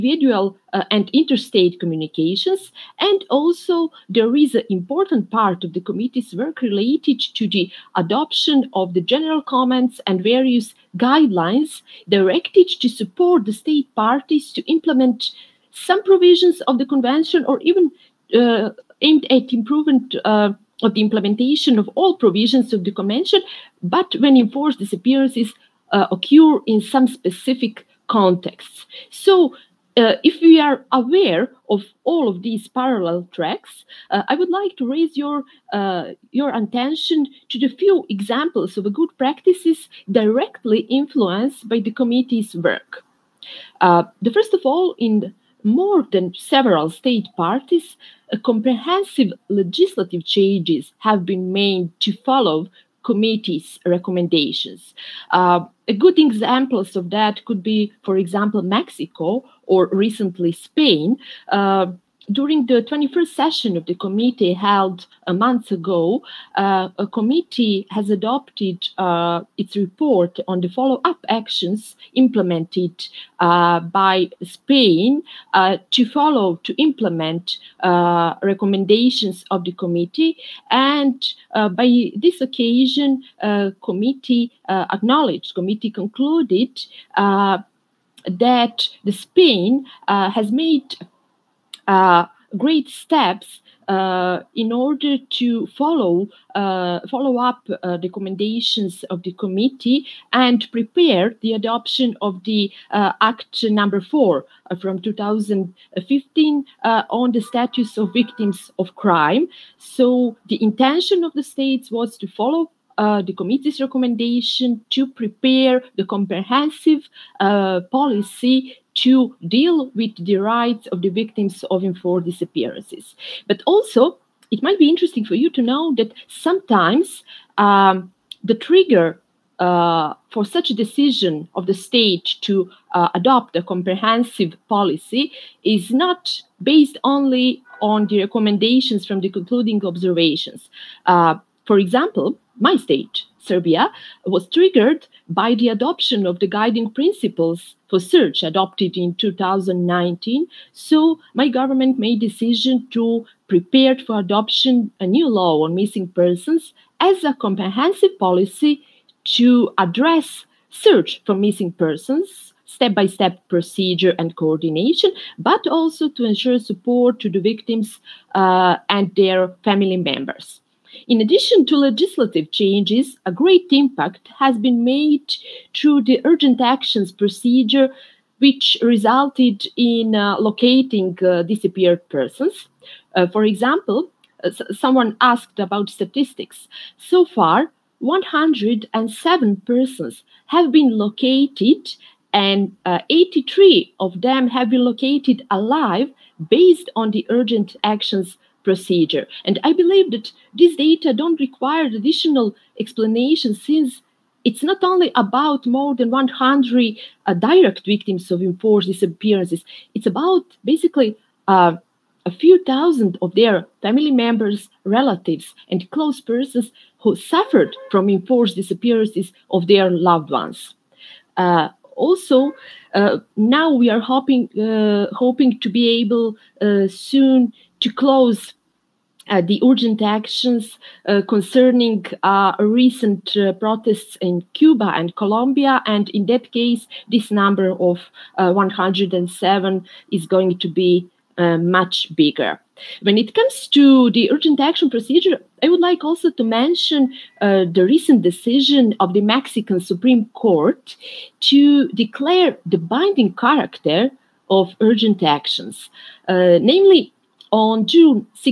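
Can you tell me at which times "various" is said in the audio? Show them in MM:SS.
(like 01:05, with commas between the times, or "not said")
00:10.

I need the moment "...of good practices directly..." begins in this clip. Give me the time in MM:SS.
00:38.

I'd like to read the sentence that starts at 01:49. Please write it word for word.
So the intention of the states was to follow.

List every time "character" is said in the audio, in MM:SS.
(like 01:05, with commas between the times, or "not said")
04:13.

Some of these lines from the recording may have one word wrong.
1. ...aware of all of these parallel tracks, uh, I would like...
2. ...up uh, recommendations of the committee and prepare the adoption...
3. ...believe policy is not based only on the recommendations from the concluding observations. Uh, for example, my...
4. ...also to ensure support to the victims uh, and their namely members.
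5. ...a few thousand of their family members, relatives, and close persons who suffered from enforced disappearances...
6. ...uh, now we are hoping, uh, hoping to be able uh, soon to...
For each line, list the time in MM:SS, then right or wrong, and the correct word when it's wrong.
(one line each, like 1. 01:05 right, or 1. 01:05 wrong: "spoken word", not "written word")
1. 00:30 right
2. 01:37 right
3. 02:13 wrong: "comprehensive", not "believe"
4. 02:45 wrong: "family", not "namely"
5. 03:32 right
6. 03:42 right.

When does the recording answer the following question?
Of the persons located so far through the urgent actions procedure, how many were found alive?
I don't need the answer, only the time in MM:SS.
03:13.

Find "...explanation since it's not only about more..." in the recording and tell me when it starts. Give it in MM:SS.
03:22.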